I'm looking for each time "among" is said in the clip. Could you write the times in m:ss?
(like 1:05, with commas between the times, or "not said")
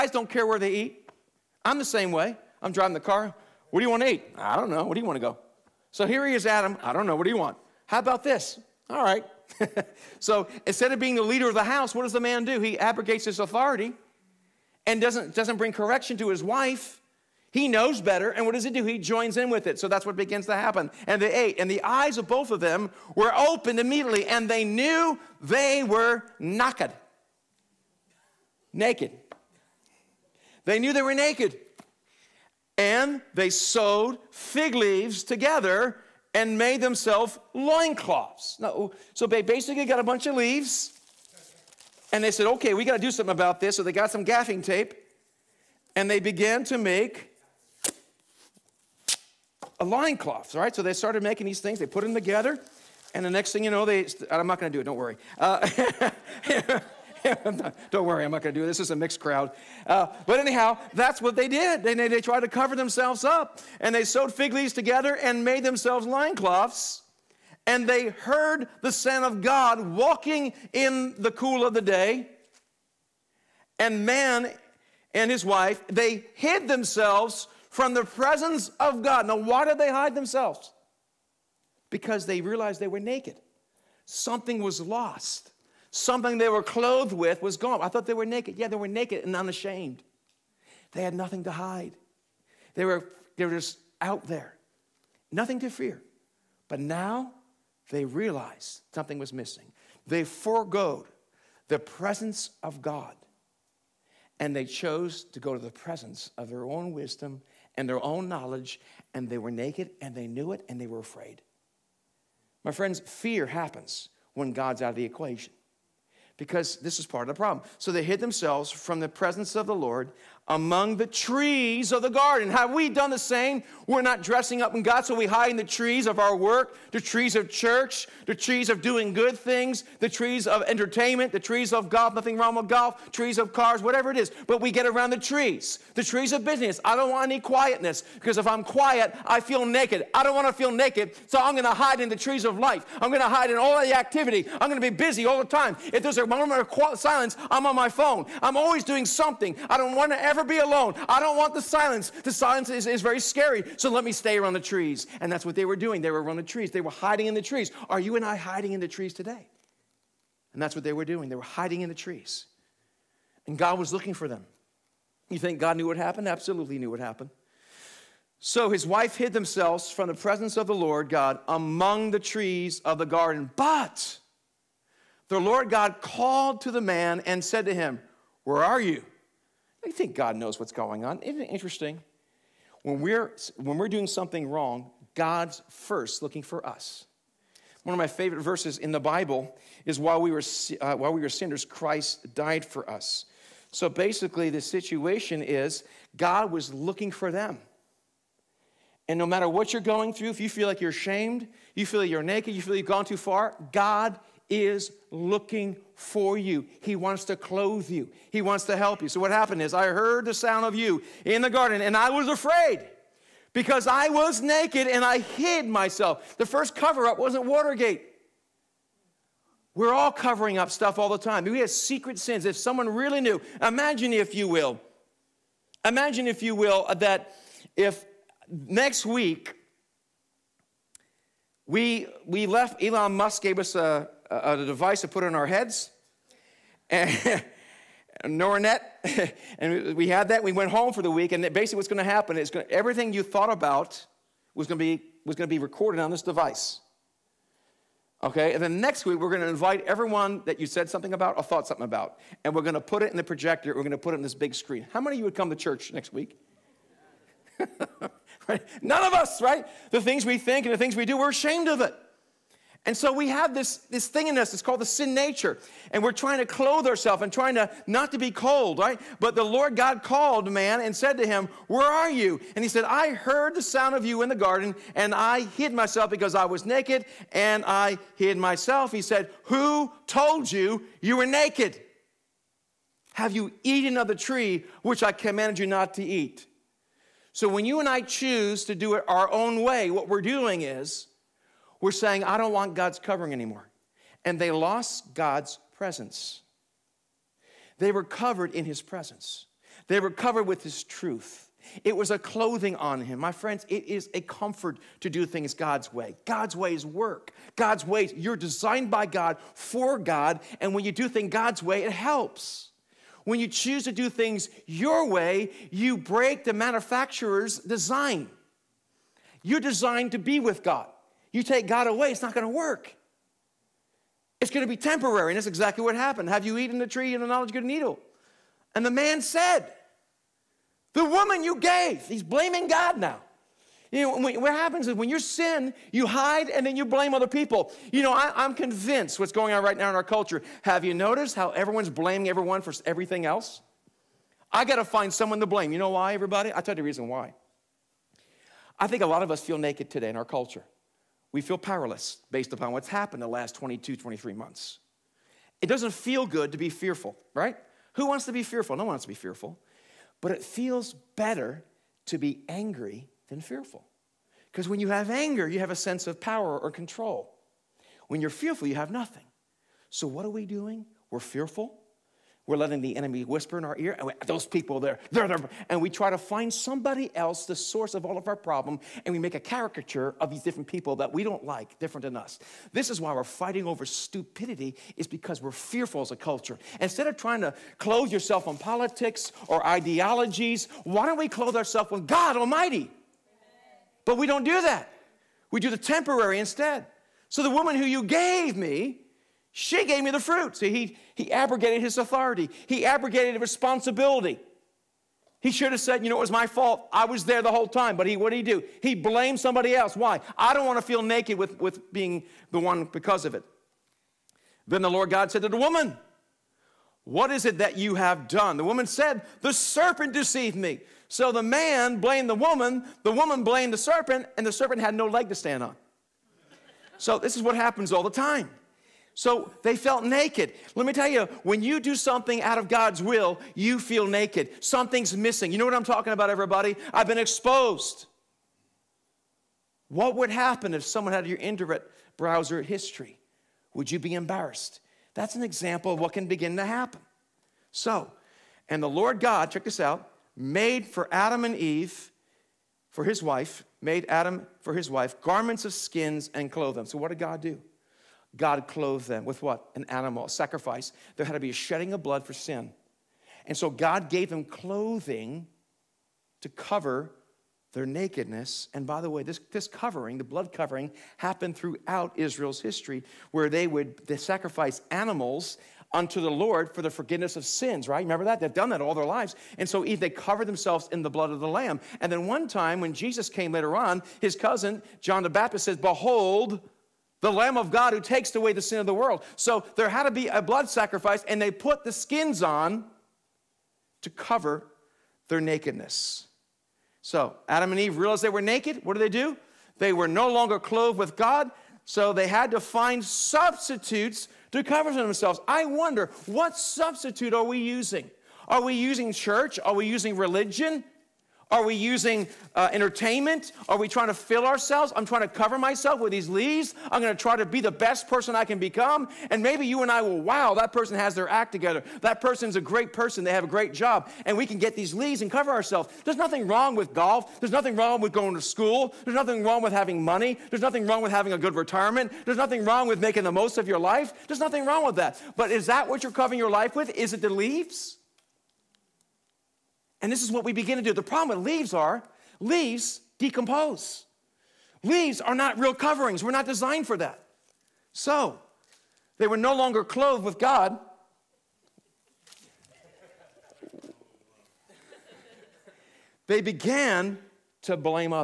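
2:00, 2:51.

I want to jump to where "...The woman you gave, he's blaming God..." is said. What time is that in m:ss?
5:30.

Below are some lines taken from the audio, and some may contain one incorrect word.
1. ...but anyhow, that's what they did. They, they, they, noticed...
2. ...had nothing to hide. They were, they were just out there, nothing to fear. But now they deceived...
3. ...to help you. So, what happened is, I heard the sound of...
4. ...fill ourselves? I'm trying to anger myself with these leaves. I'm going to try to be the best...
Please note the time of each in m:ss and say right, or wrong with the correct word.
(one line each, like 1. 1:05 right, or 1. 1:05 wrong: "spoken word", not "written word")
1. 1:00 wrong: "tried", not "noticed"
2. 1:31 wrong: "realized", not "deceived"
3. 3:28 right
4. 8:34 wrong: "cover", not "anger".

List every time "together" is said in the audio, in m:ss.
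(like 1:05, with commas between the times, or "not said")
0:35, 0:52, 1:04, 8:41.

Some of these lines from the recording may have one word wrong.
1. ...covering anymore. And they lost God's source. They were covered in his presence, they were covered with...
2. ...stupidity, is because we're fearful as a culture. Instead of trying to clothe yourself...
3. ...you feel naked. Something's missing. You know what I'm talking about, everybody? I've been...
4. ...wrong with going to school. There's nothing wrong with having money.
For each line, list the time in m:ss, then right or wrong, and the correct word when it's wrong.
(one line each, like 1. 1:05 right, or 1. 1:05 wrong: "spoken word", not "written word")
1. 4:52 wrong: "presence", not "source"
2. 6:23 right
3. 7:13 right
4. 8:47 right.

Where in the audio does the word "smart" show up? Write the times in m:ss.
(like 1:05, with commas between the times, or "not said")
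not said.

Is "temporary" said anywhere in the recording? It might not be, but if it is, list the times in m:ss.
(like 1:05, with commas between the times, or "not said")
5:24, 6:35.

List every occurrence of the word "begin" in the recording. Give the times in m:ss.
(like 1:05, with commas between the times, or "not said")
0:20, 7:26, 9:00.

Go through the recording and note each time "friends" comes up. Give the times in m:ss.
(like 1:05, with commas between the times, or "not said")
1:52, 5:03.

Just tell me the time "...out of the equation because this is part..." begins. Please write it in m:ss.
1:54.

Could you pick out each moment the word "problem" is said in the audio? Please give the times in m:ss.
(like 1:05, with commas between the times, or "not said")
1:57, 6:18, 9:01.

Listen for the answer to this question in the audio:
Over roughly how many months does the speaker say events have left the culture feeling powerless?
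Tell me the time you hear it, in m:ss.
5:53.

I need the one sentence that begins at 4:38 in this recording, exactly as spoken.
He said, Who told you you were naked?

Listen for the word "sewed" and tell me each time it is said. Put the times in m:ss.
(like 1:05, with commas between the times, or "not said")
0:33, 1:04.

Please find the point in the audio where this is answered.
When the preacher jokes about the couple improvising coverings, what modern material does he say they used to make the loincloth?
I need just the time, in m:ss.
0:44.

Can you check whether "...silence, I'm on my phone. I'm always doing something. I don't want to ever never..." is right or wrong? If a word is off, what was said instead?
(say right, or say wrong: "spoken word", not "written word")
right.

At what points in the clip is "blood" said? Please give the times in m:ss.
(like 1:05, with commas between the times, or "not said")
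7:42, 7:50, 8:01, 8:10.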